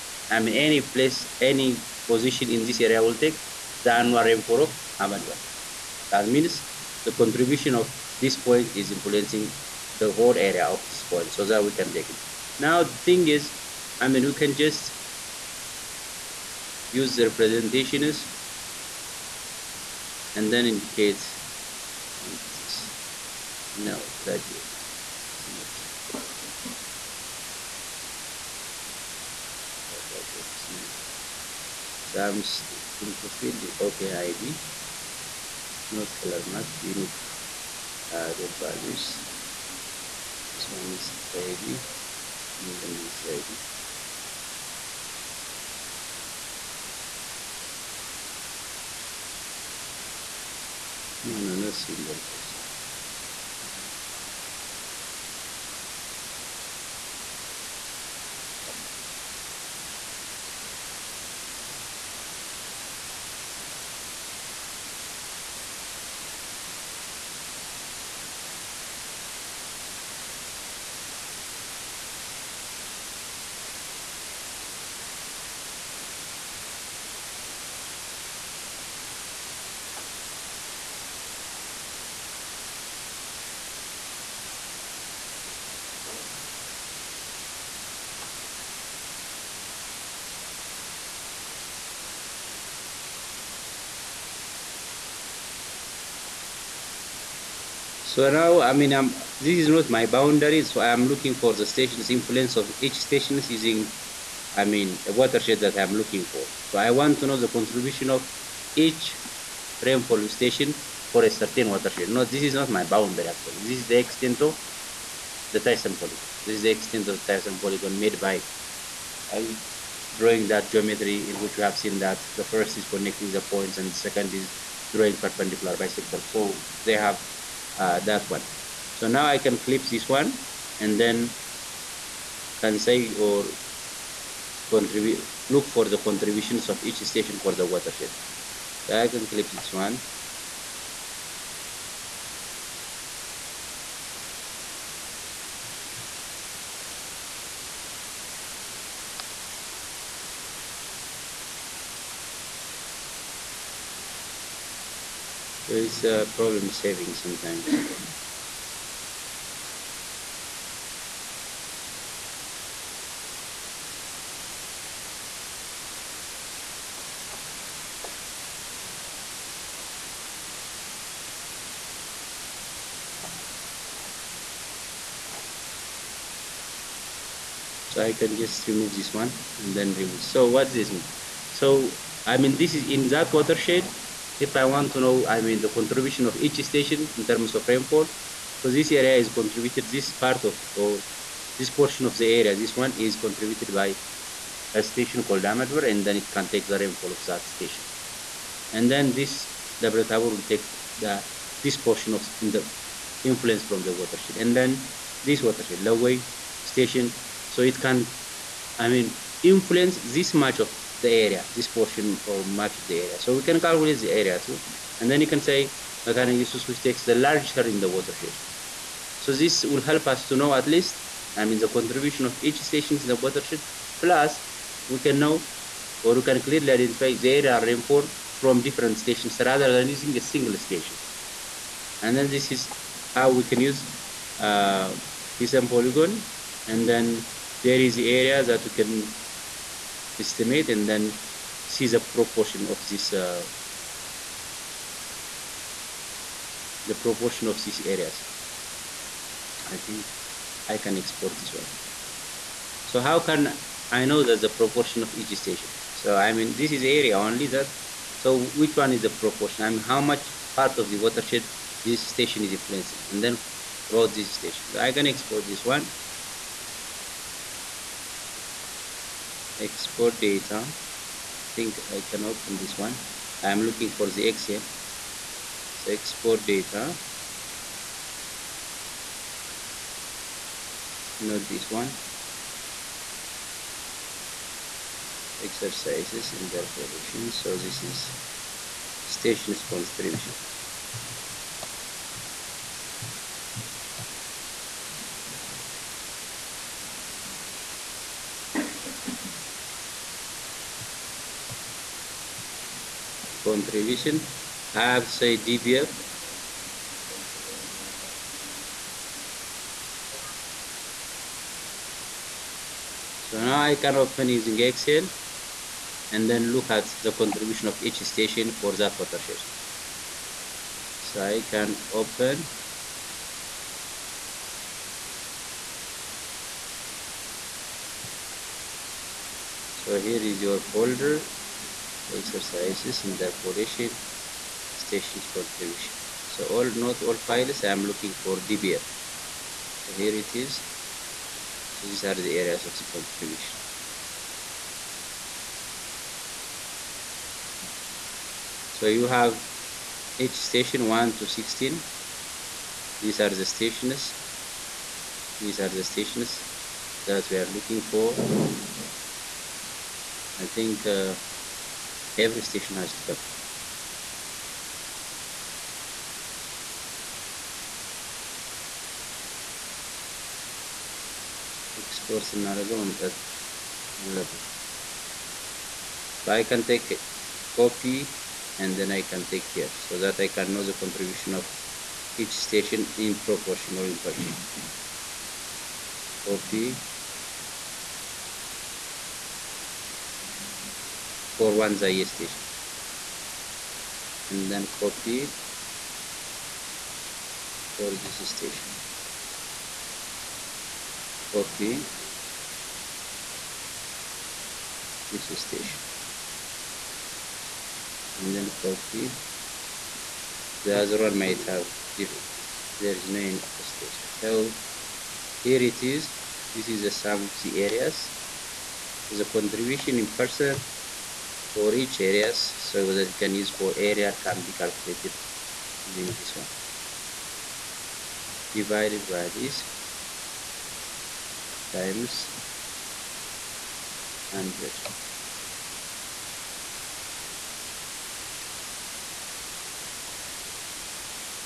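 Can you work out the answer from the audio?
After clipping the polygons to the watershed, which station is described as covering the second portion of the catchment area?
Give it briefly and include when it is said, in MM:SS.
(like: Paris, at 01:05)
Debre Tabor, at 03:19.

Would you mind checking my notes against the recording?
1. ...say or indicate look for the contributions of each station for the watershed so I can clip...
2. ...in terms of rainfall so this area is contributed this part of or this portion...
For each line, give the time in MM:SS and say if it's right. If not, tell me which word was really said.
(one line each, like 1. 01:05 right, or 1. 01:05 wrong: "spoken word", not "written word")
1. 02:12 wrong: "contribute", not "indicate"
2. 03:07 right.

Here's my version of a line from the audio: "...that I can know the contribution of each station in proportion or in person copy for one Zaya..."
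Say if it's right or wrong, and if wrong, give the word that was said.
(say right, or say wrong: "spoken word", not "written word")
right.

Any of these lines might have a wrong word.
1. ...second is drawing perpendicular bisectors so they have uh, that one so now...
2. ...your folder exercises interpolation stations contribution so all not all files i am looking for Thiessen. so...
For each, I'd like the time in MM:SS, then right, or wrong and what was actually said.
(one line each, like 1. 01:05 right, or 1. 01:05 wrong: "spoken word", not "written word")
1. 02:04 right
2. 05:30 wrong: "DBF", not "Thiessen".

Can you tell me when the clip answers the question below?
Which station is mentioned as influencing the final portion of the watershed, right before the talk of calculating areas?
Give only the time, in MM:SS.
03:25.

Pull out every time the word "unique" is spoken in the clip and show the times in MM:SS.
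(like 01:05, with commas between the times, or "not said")
00:36.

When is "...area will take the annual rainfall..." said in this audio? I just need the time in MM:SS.
00:02.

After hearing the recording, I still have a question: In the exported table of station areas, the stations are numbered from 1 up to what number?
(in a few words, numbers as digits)
16.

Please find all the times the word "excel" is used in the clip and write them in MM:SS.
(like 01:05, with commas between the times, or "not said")
04:34, 05:14.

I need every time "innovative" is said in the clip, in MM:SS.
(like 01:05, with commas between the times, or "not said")
not said.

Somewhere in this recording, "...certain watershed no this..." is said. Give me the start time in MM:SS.
01:51.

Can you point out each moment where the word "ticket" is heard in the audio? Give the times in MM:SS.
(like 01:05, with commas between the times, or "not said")
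not said.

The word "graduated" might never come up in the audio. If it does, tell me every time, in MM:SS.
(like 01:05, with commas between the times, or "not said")
00:24.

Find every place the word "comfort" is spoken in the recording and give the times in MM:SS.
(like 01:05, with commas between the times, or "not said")
not said.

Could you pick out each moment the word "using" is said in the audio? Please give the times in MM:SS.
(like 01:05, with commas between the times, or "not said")
01:43, 03:49, 05:14, 07:05.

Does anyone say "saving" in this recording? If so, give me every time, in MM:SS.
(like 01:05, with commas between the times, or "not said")
02:36.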